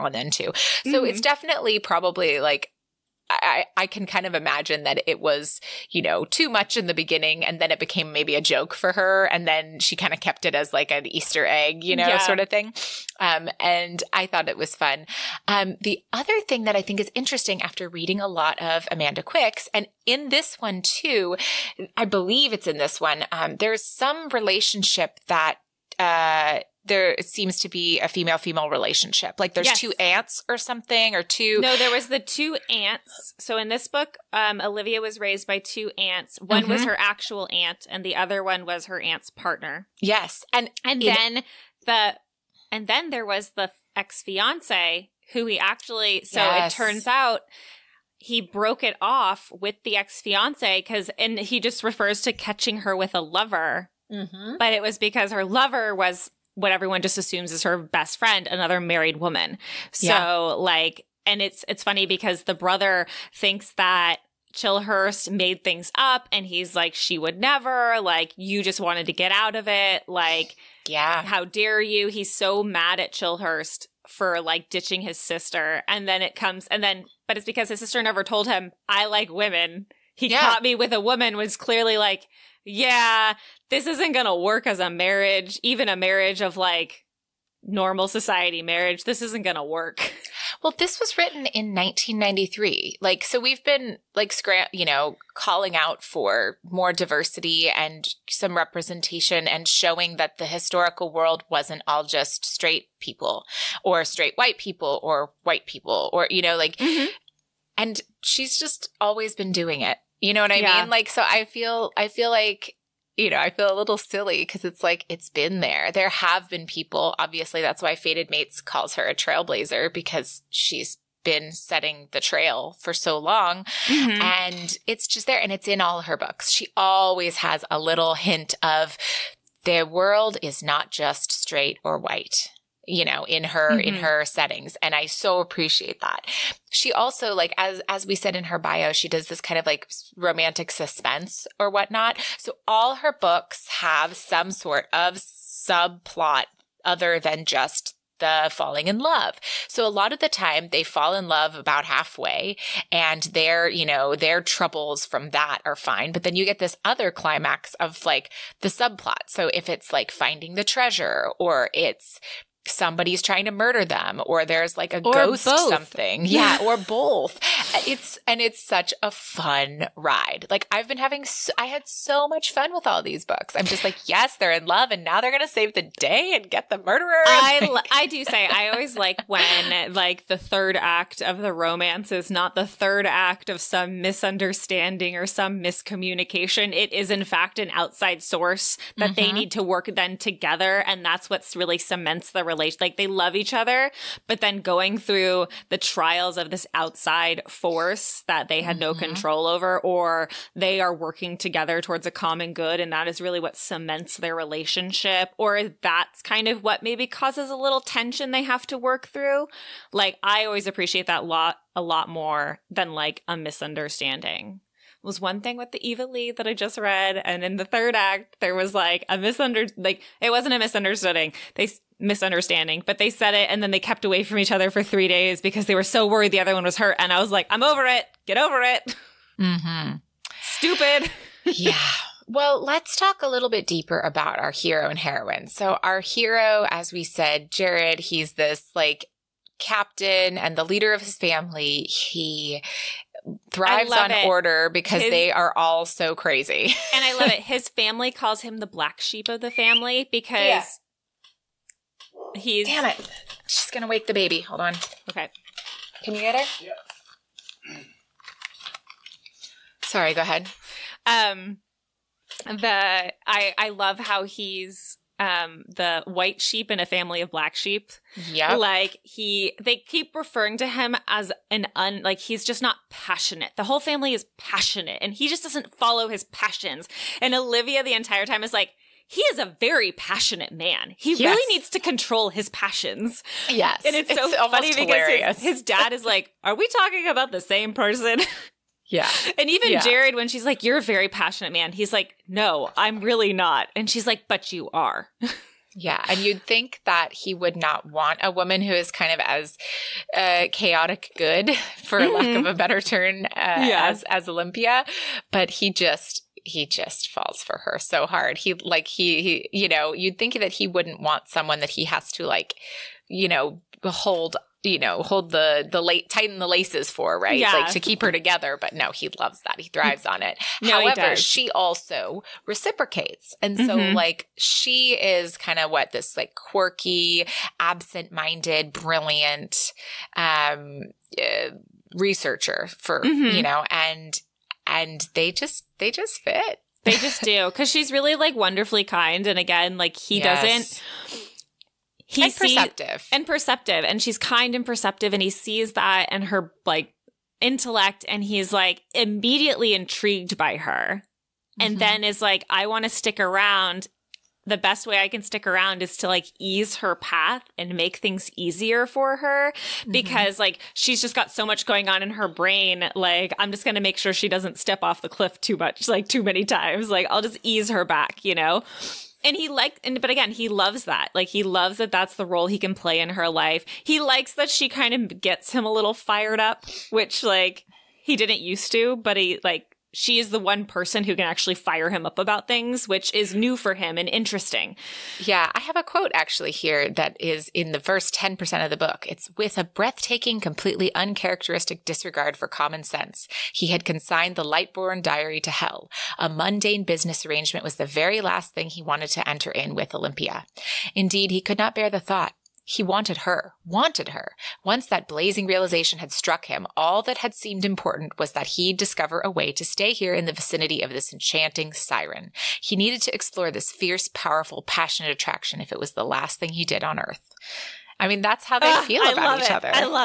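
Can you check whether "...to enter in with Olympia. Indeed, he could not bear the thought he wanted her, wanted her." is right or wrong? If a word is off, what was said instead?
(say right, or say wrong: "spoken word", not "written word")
right.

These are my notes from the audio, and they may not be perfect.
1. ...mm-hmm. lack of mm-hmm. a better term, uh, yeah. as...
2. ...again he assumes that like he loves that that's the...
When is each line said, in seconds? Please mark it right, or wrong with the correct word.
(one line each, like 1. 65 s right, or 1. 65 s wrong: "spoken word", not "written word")
1. 301 s right
2. 370 s wrong: "loves", not "assumes".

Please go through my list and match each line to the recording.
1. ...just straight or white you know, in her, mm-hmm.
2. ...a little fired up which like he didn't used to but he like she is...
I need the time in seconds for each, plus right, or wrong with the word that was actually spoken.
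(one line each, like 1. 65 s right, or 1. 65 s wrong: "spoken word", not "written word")
1. 130 s right
2. 375 s right.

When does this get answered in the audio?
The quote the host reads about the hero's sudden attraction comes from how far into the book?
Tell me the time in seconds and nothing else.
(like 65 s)
387 s.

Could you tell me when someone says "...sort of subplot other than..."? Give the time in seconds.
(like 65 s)
144 s.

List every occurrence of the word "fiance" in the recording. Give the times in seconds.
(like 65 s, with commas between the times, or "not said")
44 s, 50 s.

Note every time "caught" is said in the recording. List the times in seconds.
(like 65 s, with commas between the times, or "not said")
80 s.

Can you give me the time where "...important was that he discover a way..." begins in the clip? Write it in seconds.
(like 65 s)
407 s.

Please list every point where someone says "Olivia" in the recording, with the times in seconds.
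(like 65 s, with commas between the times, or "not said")
34 s, 277 s.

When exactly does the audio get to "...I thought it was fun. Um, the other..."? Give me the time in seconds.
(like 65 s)
14 s.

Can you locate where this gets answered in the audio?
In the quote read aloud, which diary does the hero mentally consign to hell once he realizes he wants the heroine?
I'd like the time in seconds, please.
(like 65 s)
394 s.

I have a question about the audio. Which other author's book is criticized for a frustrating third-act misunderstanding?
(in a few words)
Eva Leigh.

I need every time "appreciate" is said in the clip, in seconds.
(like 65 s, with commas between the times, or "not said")
135 s, 210 s.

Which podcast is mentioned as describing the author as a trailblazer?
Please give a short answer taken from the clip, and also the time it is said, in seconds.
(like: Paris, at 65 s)
Fated Mates, at 117 s.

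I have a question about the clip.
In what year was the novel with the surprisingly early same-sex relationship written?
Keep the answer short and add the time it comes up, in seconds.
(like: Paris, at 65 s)
1993, at 91 s.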